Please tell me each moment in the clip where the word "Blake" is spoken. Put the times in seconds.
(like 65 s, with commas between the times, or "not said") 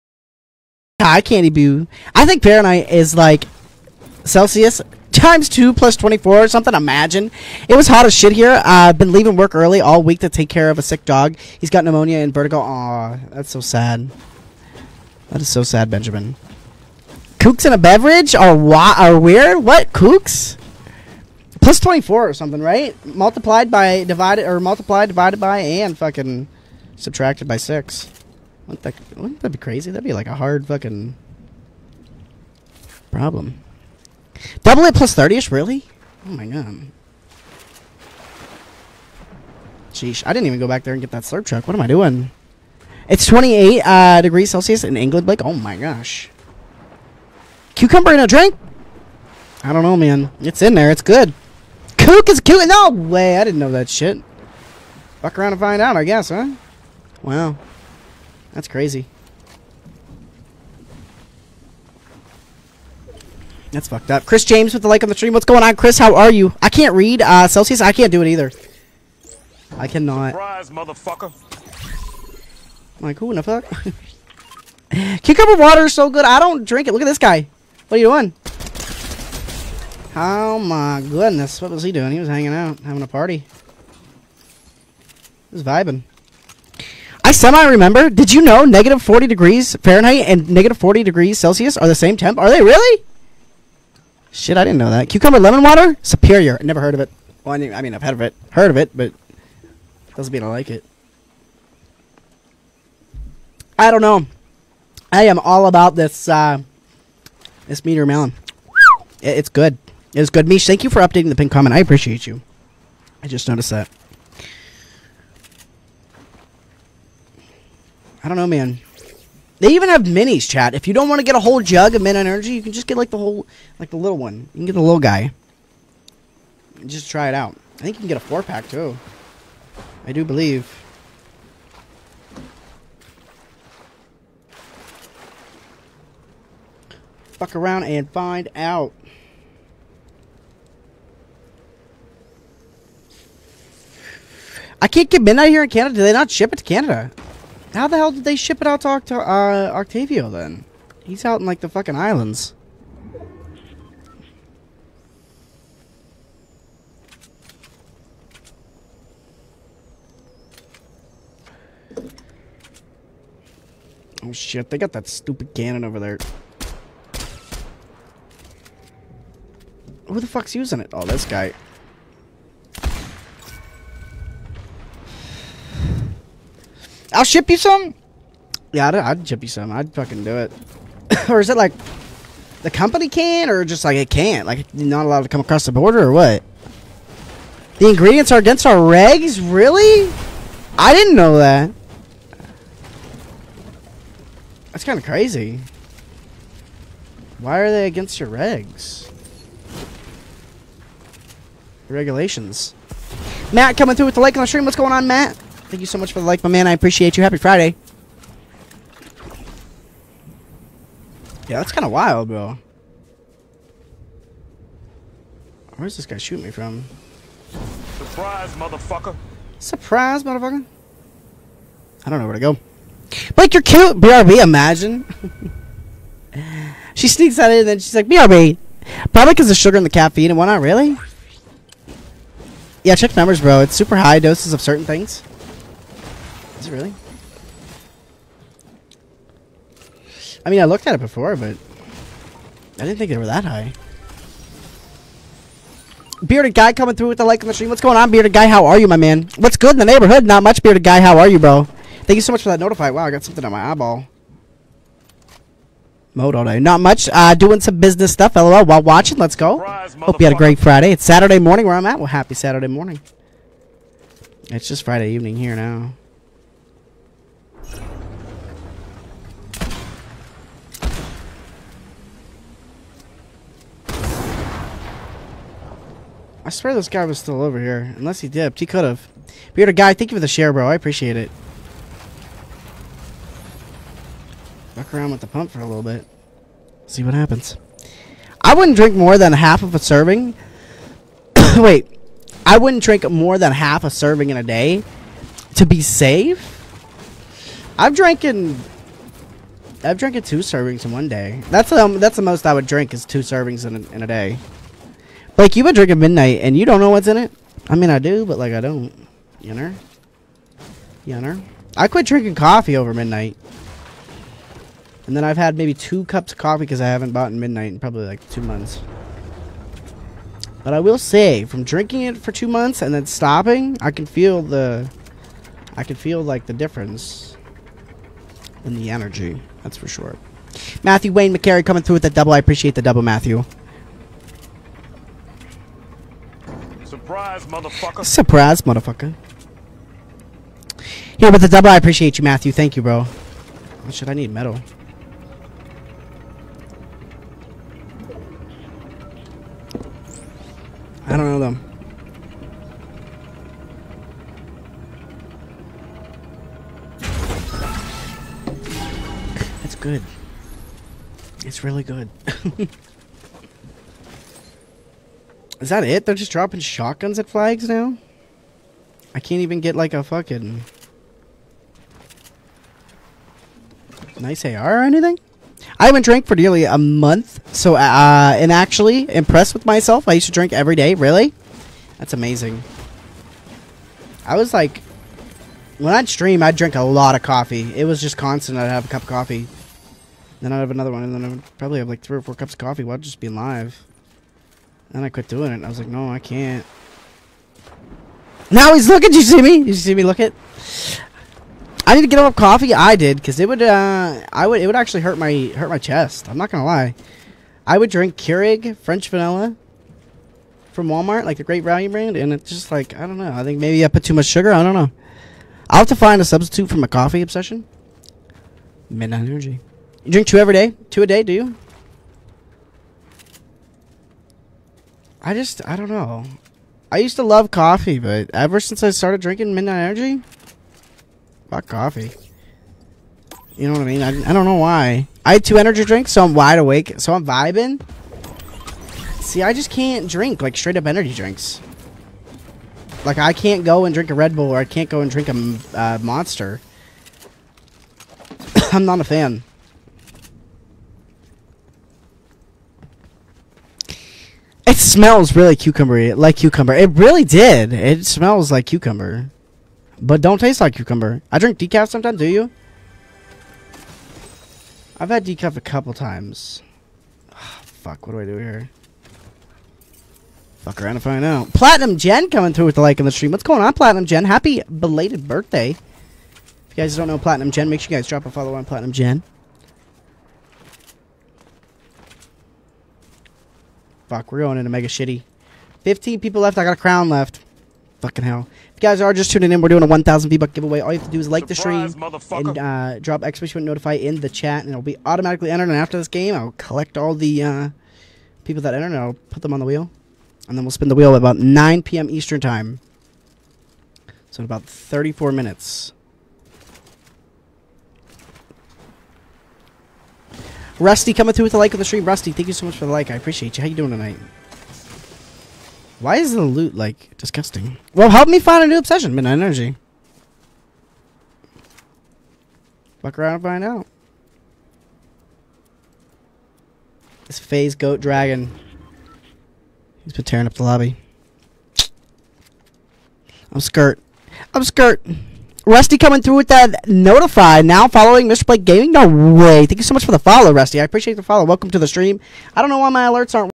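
45 s, 538 s.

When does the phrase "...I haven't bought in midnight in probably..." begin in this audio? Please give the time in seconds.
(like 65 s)
316 s.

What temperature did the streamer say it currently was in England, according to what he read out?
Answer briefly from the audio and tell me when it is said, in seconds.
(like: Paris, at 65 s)
28 degrees Celsius, at 43 s.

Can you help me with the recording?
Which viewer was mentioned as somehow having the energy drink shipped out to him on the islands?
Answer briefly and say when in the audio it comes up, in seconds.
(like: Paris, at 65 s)
Octavio, at 149 s.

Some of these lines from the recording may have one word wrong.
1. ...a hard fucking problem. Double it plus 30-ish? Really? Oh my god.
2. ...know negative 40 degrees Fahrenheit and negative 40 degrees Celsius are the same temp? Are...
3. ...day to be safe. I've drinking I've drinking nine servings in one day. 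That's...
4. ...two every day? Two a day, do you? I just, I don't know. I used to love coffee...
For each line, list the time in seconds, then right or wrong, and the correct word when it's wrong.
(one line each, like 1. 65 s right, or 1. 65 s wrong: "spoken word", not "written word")
1. 30 s right
2. 88 s right
3. 294 s wrong: "two", not "nine"
4. 420 s right.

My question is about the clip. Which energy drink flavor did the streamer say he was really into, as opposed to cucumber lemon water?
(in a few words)
meteor melon.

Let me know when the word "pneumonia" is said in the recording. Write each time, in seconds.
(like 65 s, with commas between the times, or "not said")
11 s.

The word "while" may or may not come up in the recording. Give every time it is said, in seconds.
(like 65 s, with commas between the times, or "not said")
258 s, 392 s.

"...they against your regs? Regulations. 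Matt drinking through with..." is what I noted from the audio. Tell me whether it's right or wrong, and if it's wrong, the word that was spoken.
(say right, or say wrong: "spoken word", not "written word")
wrong: "coming", not "drinking".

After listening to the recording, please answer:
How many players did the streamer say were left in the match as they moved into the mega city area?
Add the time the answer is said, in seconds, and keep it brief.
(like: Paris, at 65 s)
15, at 485 s.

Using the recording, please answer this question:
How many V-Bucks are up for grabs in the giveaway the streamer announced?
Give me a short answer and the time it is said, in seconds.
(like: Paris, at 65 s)
1,000, at 489 s.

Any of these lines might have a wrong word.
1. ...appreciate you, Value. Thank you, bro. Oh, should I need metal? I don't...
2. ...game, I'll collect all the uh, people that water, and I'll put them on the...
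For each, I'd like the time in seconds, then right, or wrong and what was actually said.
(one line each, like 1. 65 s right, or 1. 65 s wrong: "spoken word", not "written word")
1. 341 s wrong: "Matthew", not "Value"
2. 496 s wrong: "enter", not "water".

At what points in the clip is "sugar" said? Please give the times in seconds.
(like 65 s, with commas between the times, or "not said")
229 s, 414 s.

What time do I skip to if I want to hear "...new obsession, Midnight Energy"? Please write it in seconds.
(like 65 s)
518 s.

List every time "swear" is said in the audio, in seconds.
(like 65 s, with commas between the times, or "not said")
276 s.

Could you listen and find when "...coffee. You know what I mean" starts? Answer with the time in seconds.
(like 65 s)
431 s.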